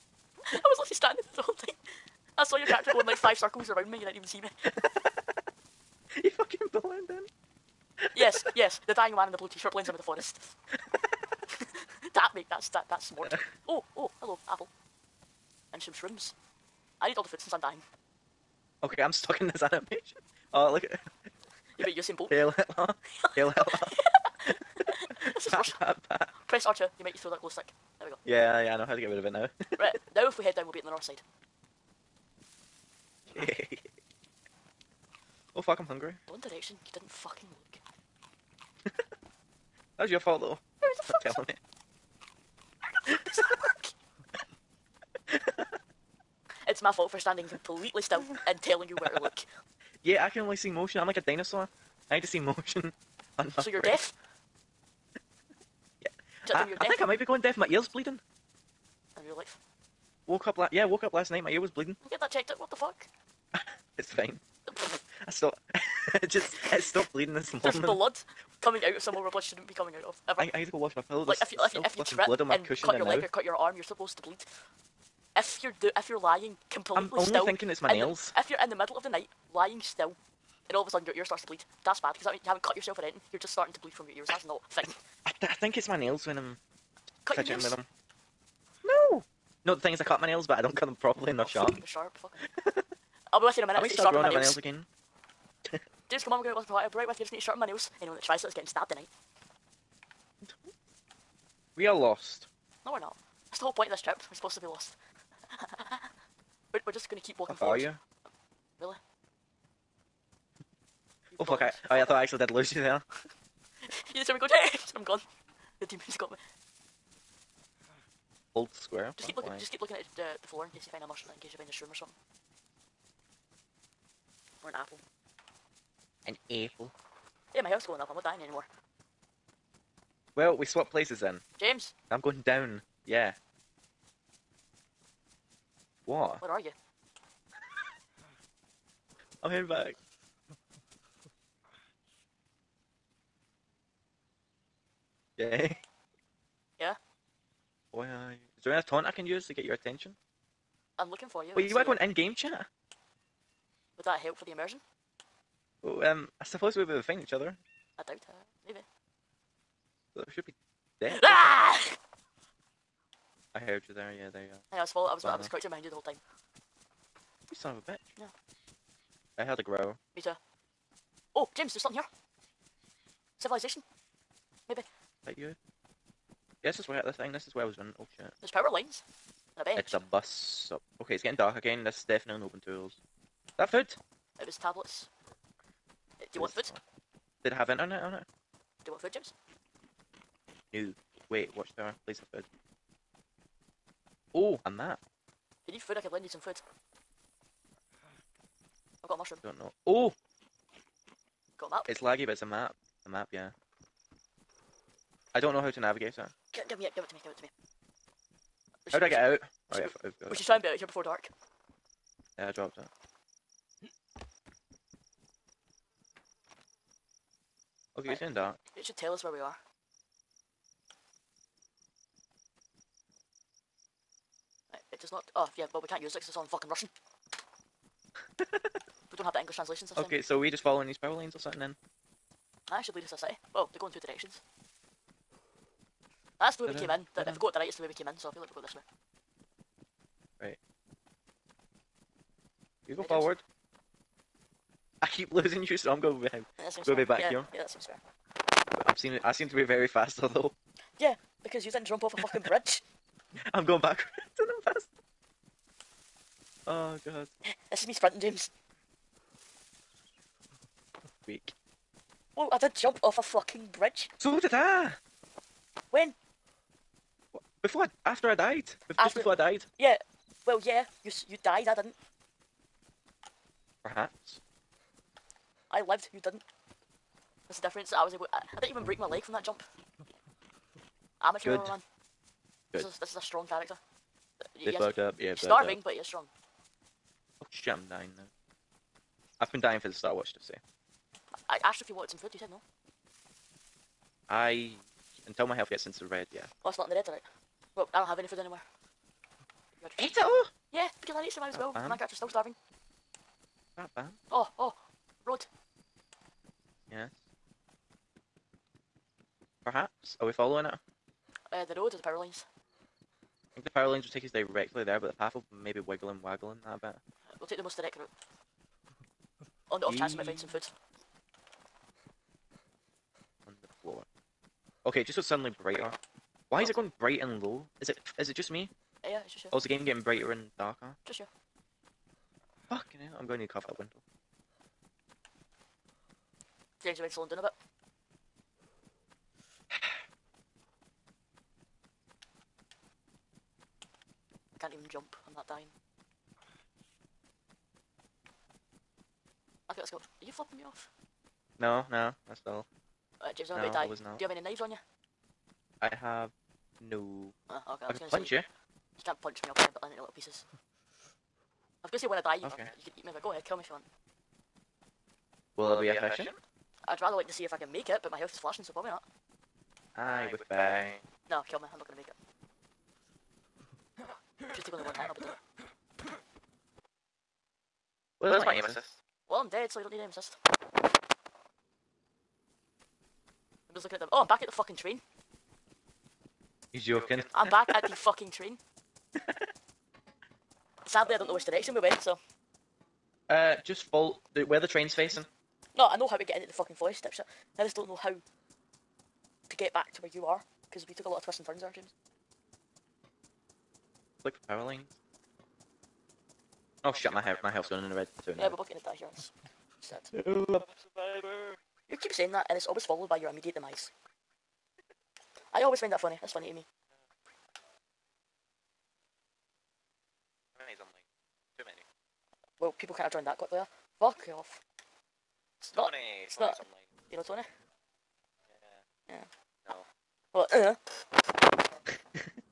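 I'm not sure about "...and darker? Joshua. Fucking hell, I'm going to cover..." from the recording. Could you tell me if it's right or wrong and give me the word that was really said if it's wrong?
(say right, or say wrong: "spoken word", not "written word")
right.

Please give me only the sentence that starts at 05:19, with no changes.
On the off chance we might find some food.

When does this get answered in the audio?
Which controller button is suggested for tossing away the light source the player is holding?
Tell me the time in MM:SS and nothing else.
00:26.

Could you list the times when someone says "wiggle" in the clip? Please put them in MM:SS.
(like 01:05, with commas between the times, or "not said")
05:15.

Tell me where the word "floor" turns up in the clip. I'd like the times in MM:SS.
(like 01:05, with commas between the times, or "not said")
02:00, 05:23.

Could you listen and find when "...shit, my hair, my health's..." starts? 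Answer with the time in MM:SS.
06:46.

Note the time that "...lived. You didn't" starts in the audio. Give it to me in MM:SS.
04:35.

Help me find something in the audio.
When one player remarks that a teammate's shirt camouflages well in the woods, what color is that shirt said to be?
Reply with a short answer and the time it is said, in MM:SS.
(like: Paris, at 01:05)
blue, at 00:09.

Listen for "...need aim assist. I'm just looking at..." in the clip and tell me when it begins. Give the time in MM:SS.
06:19.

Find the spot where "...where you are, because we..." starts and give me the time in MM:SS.
06:39.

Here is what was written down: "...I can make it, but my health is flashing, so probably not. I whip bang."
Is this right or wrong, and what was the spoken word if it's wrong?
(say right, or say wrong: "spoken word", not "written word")
right.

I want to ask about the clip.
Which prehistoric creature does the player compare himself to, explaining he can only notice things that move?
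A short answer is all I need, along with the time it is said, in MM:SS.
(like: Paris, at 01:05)
dinosaur, at 00:51.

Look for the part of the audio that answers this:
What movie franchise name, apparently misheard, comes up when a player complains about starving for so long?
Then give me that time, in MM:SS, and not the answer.
04:49.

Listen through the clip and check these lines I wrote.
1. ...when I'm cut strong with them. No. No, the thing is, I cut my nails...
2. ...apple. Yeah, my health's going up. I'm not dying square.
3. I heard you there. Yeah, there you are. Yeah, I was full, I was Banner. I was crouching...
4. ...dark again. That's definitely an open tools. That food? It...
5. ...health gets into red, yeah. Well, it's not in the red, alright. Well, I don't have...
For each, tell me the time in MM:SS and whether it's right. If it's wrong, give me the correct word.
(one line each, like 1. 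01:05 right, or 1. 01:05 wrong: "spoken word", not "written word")
1. 01:26 wrong: "fidgeting", not "strong"
2. 02:06 wrong: "anymore", not "square"
3. 02:43 right
4. 03:01 right
5. 04:55 right.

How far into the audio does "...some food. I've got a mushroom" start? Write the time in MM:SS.
03:16.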